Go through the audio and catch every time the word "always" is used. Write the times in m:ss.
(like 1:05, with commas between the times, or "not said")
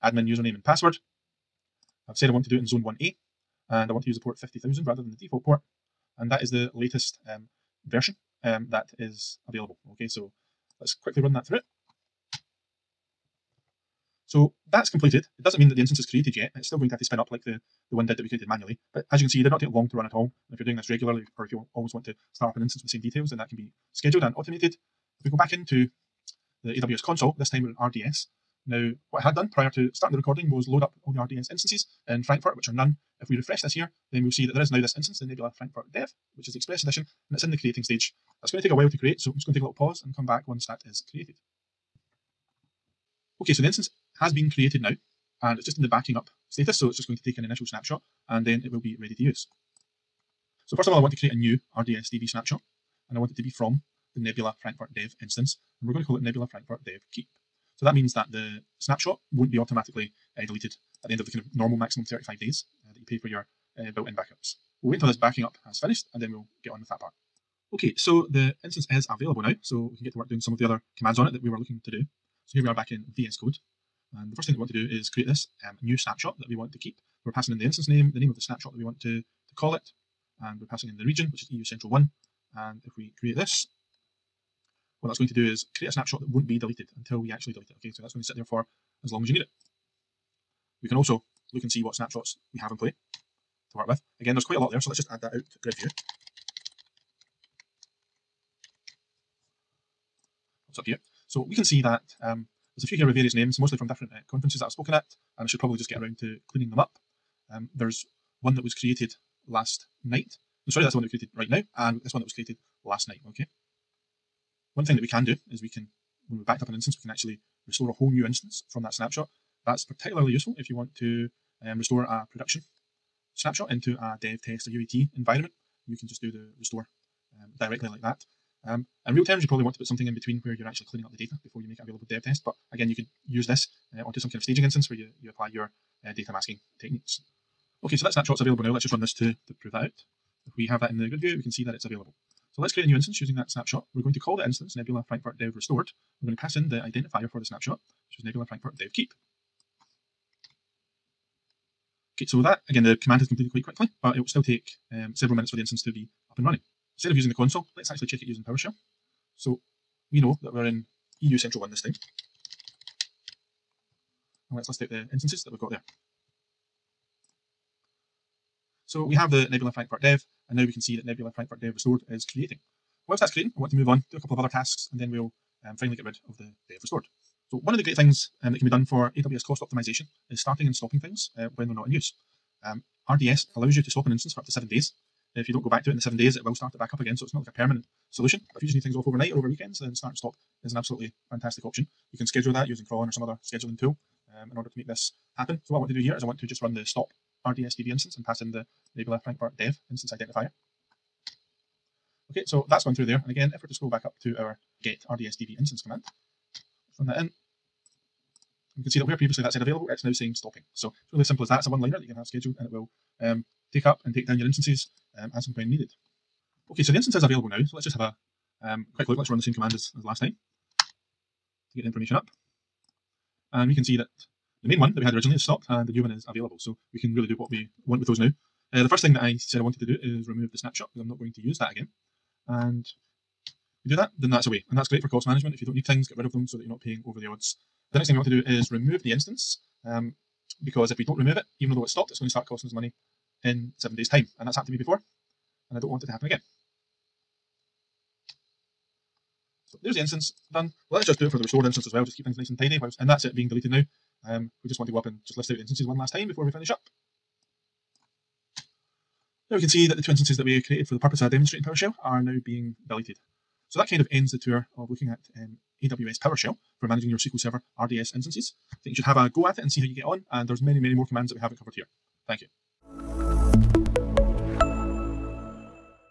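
0:21.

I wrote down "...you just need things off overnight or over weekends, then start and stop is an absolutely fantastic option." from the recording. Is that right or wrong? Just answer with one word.
right.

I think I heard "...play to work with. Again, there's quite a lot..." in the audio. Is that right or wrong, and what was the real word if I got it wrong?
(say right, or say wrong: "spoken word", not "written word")
right.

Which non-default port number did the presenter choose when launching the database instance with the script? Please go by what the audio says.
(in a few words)
50000.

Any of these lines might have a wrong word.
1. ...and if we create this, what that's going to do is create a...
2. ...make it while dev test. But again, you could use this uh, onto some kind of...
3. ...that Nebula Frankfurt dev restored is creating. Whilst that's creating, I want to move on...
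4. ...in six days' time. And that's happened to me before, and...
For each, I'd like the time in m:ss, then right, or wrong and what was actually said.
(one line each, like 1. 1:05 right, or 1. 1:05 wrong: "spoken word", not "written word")
1. 1:22 right
2. 2:11 wrong: "available", not "while"
3. 2:50 right
4. 4:03 wrong: "seven", not "six".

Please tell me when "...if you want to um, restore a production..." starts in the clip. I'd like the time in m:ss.
2:00.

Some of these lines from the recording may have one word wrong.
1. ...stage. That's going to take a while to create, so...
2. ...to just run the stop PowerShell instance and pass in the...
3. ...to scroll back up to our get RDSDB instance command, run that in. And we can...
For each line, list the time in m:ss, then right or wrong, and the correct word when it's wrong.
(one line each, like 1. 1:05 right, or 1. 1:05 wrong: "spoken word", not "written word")
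1. 0:37 right
2. 3:16 wrong: "RDSDB", not "PowerShell"
3. 3:23 right.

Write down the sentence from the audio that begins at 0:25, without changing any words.
If we go back into the AWS console, this time we're in RDS.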